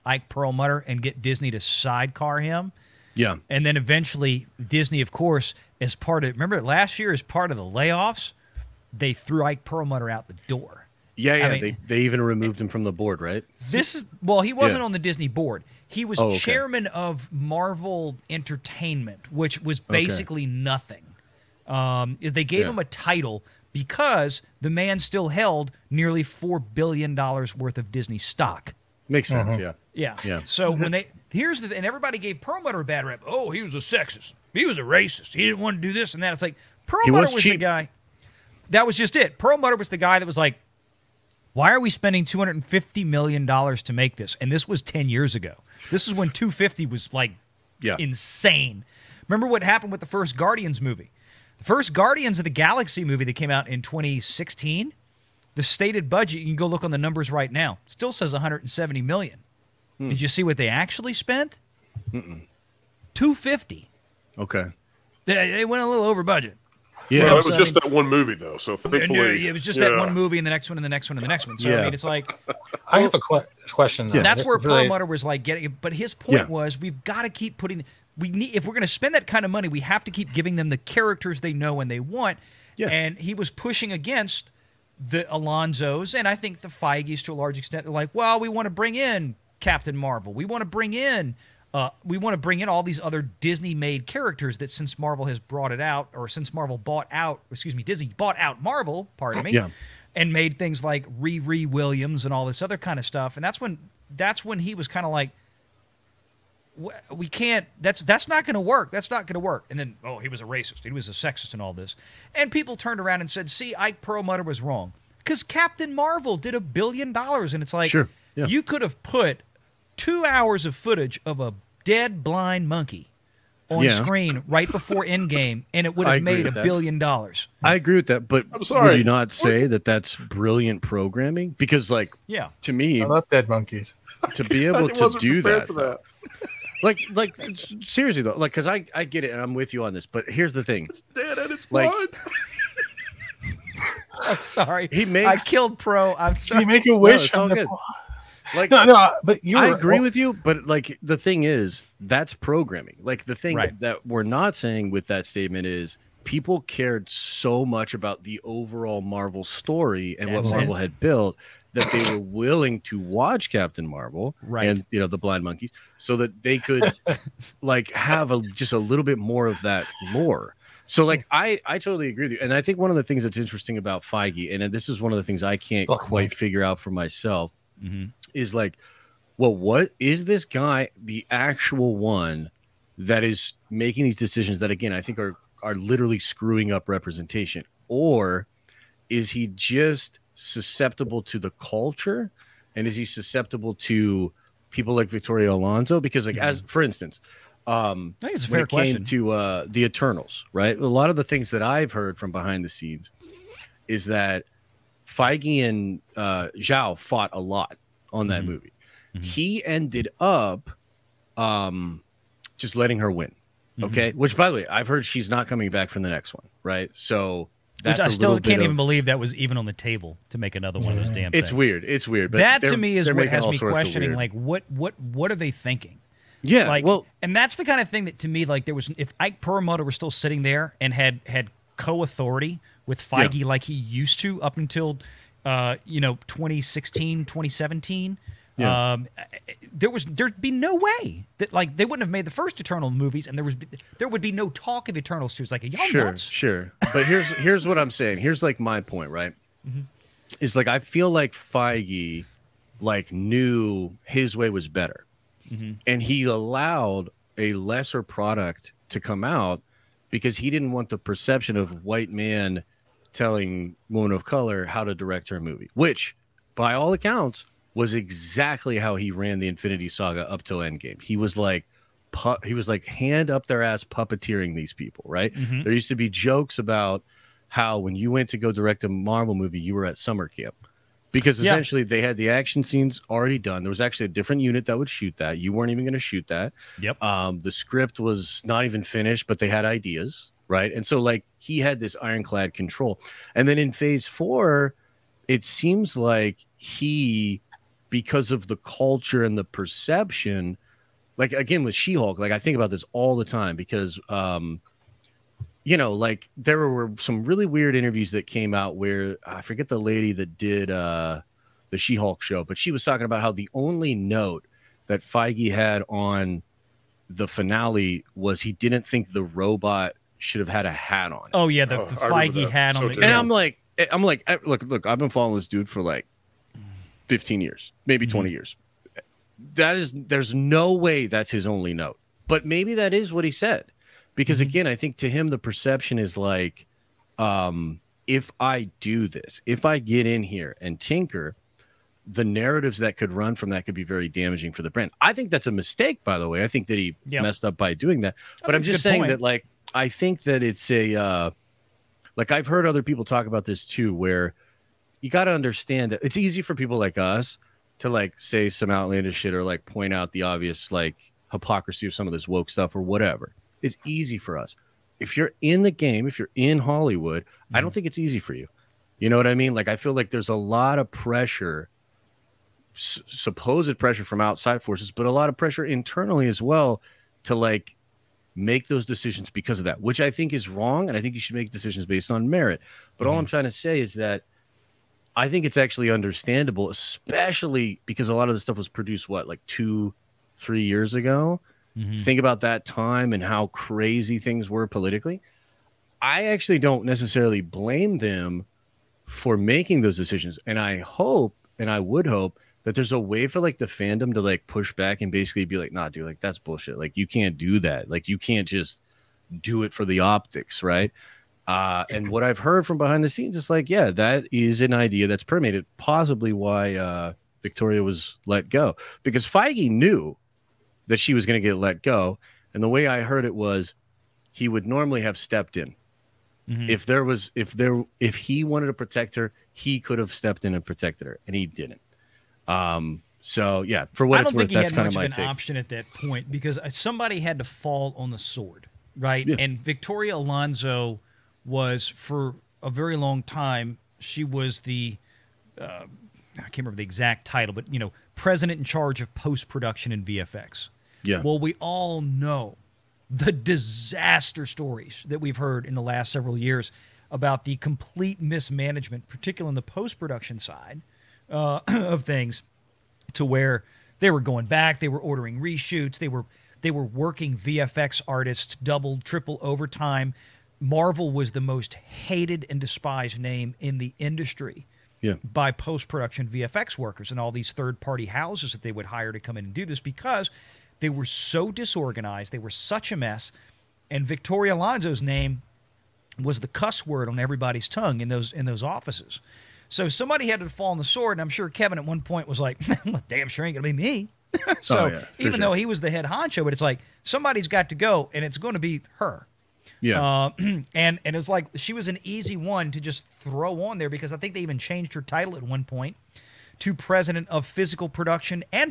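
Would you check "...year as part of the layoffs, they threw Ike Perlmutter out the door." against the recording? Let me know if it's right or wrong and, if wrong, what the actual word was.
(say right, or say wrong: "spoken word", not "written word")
right.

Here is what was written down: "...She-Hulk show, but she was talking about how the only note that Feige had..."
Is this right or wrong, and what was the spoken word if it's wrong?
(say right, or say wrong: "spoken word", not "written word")
right.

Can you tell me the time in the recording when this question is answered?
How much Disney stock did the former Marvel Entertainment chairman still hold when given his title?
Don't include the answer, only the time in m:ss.
0:25.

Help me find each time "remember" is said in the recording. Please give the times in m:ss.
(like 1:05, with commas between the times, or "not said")
0:06, 0:49, 7:26.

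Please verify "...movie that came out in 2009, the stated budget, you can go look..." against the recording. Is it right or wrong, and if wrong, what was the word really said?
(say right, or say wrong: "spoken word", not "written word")
wrong: "2016", not "2009".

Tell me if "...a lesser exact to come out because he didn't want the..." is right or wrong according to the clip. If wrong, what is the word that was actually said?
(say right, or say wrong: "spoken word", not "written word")
wrong: "product", not "exact".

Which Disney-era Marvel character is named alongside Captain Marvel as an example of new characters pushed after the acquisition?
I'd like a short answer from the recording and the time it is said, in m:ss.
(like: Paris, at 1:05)
Riri Williams, at 1:41.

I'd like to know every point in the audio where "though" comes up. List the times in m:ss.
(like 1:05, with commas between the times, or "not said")
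1:08, 1:14, 2:18, 8:15.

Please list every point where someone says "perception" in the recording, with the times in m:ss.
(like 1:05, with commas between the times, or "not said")
4:20, 4:59, 5:35.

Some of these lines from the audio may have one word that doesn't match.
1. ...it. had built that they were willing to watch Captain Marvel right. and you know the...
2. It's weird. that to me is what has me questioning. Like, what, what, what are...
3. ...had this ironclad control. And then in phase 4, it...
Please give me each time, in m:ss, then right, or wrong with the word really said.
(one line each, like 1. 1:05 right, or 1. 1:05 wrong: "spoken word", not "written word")
1. 2:40 right
2. 3:41 right
3. 4:51 right.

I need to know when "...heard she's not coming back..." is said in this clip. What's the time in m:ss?
3:34.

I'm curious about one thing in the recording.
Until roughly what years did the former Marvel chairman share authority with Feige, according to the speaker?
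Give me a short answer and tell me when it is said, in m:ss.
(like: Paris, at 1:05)
2016, 2017, at 3:56.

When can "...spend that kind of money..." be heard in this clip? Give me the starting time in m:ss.
1:18.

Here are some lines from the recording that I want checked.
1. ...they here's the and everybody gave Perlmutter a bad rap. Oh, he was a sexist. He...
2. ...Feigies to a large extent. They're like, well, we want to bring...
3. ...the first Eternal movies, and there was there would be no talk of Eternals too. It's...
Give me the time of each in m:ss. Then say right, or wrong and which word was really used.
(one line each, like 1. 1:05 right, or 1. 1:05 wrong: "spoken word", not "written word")
1. 0:30 right
2. 1:26 right
3. 4:02 right.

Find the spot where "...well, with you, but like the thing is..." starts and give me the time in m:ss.
2:29.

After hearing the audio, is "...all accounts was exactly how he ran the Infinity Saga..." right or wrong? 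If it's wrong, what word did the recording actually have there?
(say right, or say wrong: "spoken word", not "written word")
right.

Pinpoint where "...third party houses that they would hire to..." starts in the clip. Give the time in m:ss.
7:57.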